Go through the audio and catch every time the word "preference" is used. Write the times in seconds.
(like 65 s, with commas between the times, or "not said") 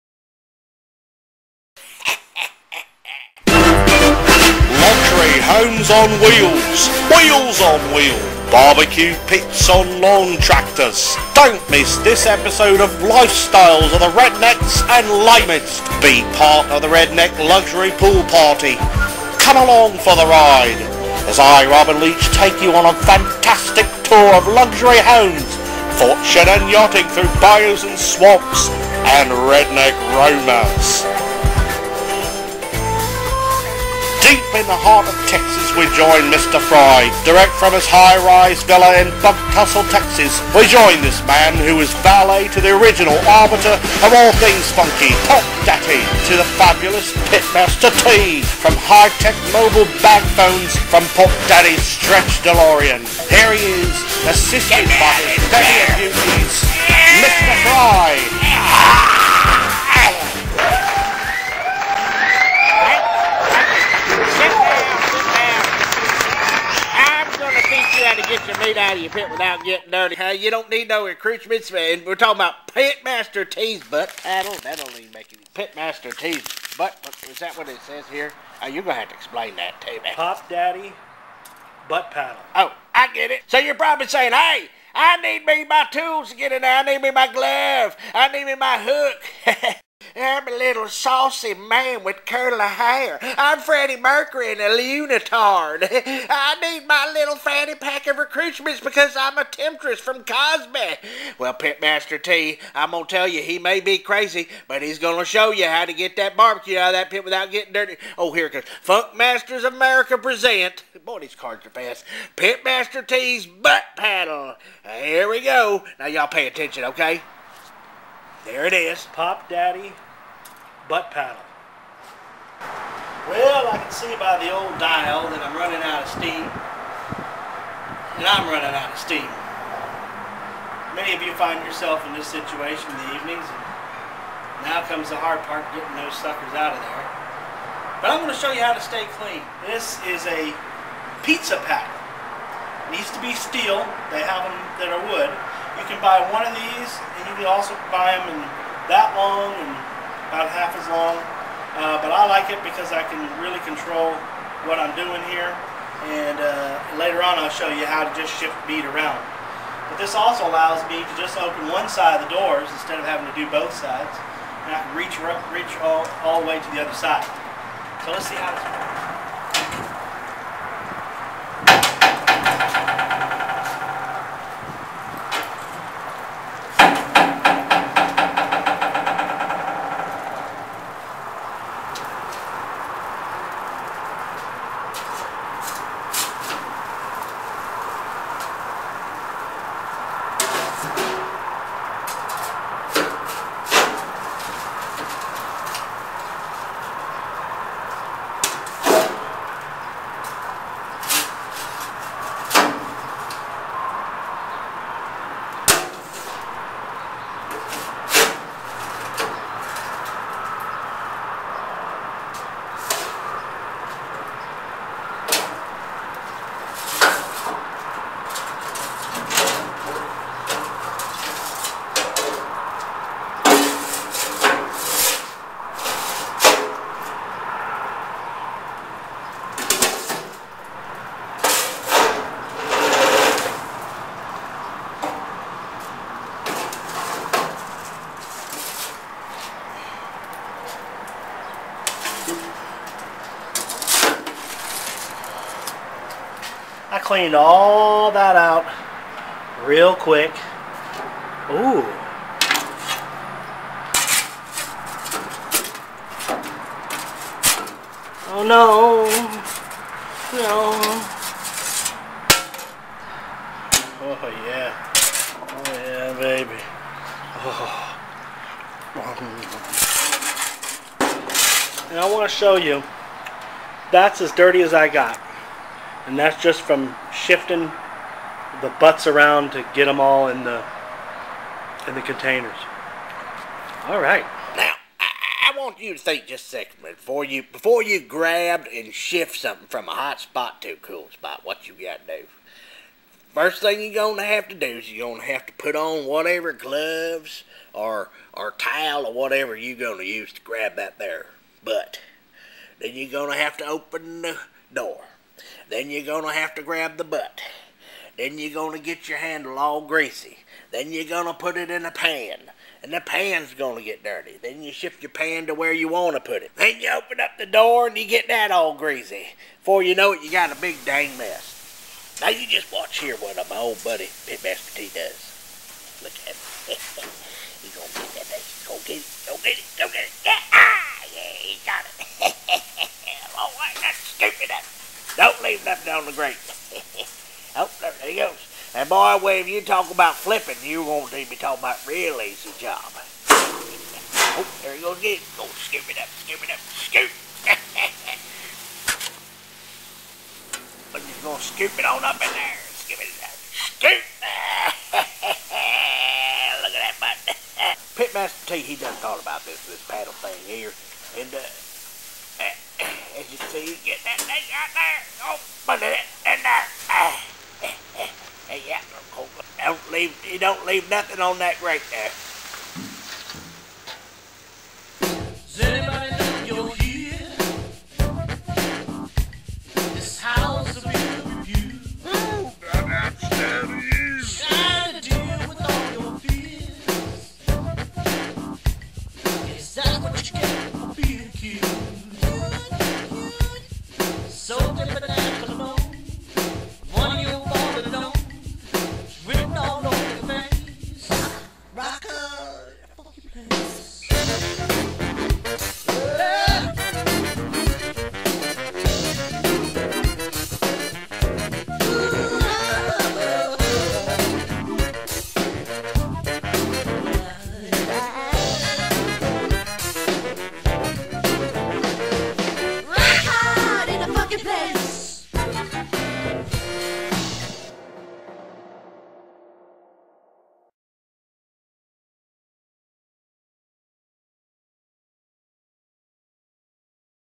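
not said.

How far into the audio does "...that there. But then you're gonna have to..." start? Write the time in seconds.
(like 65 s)
300 s.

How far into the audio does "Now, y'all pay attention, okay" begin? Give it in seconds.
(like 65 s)
115 s.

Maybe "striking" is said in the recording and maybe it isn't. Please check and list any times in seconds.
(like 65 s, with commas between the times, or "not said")
not said.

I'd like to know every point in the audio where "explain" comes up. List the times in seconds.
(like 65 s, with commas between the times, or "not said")
79 s.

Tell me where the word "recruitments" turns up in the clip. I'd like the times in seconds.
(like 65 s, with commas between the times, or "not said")
98 s.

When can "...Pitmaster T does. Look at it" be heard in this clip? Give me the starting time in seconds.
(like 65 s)
324 s.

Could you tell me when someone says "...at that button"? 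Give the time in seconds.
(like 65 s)
356 s.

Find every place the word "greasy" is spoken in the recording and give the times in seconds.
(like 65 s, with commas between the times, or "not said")
309 s, 318 s.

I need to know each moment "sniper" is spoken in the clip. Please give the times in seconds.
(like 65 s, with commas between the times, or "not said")
not said.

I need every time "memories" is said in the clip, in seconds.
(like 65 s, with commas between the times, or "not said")
not said.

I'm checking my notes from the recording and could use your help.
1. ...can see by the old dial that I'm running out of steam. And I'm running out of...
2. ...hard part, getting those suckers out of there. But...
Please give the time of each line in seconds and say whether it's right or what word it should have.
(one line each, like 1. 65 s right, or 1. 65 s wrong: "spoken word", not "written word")
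1. 123 s right
2. 135 s right.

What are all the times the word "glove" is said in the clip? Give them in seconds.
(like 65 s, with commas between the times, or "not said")
87 s, 296 s.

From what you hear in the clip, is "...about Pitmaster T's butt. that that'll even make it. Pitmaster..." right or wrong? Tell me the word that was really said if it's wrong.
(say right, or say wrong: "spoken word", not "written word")
right.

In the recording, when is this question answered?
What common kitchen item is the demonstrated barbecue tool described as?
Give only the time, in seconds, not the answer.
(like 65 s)
141 s.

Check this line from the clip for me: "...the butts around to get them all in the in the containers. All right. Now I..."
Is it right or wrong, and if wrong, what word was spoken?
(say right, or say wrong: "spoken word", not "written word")
right.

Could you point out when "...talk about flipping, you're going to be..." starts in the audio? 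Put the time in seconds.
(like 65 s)
339 s.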